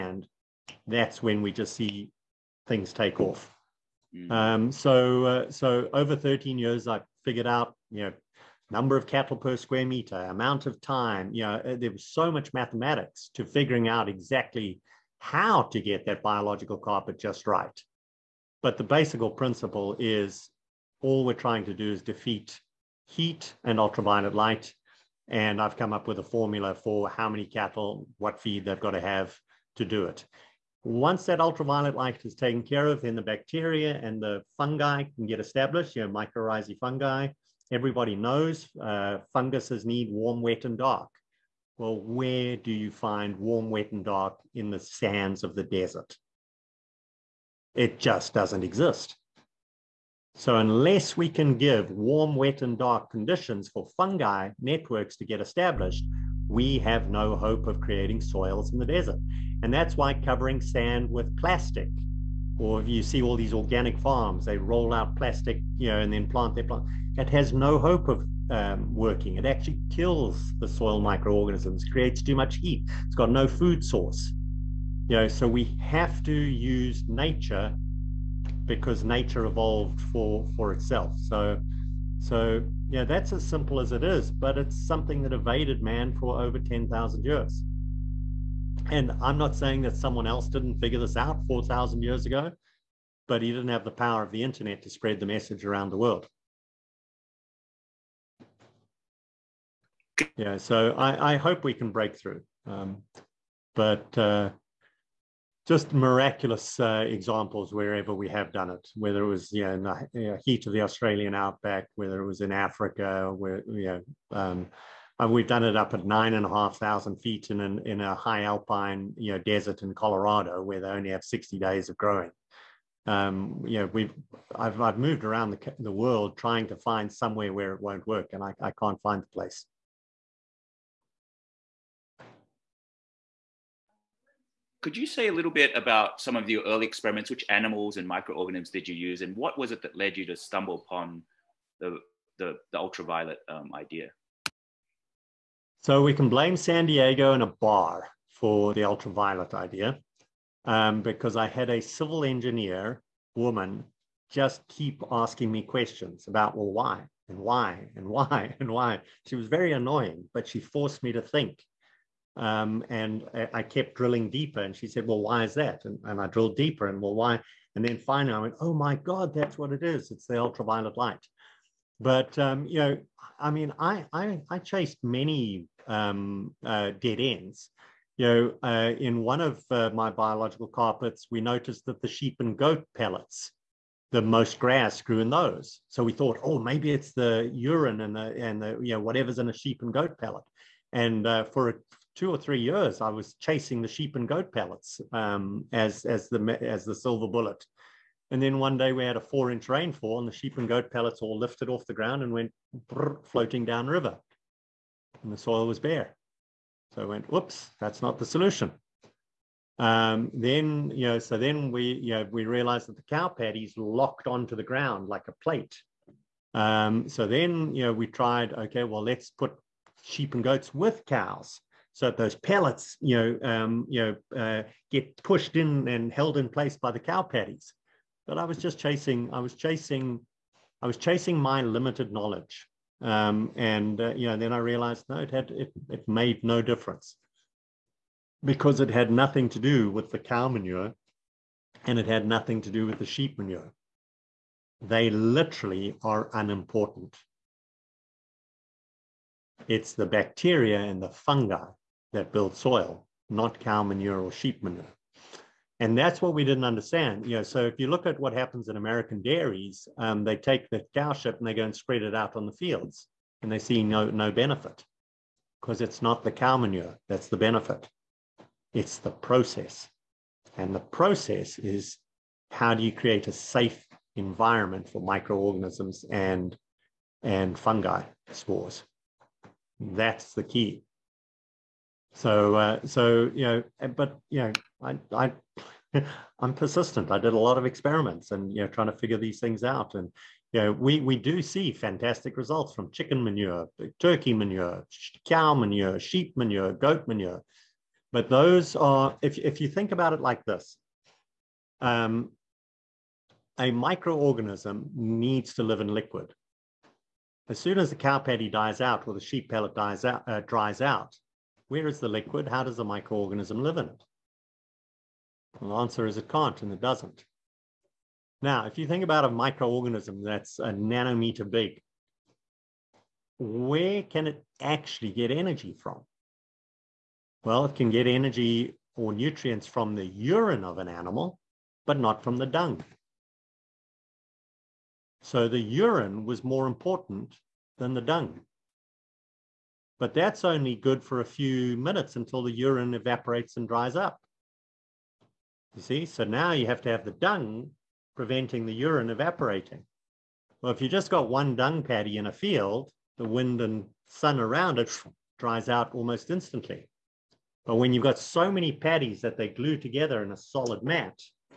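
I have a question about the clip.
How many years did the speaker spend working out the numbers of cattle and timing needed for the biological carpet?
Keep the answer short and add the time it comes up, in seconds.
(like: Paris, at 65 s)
13, at 6 s.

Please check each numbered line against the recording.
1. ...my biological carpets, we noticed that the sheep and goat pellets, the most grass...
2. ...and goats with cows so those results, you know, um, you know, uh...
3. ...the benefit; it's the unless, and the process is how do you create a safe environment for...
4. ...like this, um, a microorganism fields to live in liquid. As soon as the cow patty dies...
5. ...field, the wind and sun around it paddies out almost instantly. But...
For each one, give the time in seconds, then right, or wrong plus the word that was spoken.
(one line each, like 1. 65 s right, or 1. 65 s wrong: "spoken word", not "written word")
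1. 179 s right
2. 220 s wrong: "pellets", not "results"
3. 267 s wrong: "process", not "unless"
4. 300 s wrong: "needs", not "fields"
5. 352 s wrong: "dries", not "paddies".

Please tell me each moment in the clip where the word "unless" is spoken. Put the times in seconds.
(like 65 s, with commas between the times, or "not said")
50 s.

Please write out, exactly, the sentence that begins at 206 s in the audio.
So I went, whoops, that's not the solution.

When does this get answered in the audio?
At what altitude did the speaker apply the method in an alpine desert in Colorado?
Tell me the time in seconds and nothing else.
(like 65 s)
116 s.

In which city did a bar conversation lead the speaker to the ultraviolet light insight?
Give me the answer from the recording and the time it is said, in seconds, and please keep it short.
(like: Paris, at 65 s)
San Diego, at 146 s.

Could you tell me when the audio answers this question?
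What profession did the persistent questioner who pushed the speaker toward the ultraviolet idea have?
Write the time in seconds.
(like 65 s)
151 s.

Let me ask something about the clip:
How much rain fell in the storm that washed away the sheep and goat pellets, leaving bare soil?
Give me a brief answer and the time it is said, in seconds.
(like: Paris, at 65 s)
4 inches, at 199 s.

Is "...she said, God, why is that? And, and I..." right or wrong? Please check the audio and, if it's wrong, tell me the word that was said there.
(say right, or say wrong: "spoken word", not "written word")
wrong: "Well", not "God".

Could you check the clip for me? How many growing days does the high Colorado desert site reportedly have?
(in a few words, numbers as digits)
60.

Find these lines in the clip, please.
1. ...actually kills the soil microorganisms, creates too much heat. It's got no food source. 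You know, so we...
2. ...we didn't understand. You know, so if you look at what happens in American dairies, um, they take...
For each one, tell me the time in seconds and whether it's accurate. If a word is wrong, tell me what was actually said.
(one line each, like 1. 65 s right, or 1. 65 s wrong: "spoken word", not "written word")
1. 69 s right
2. 256 s right.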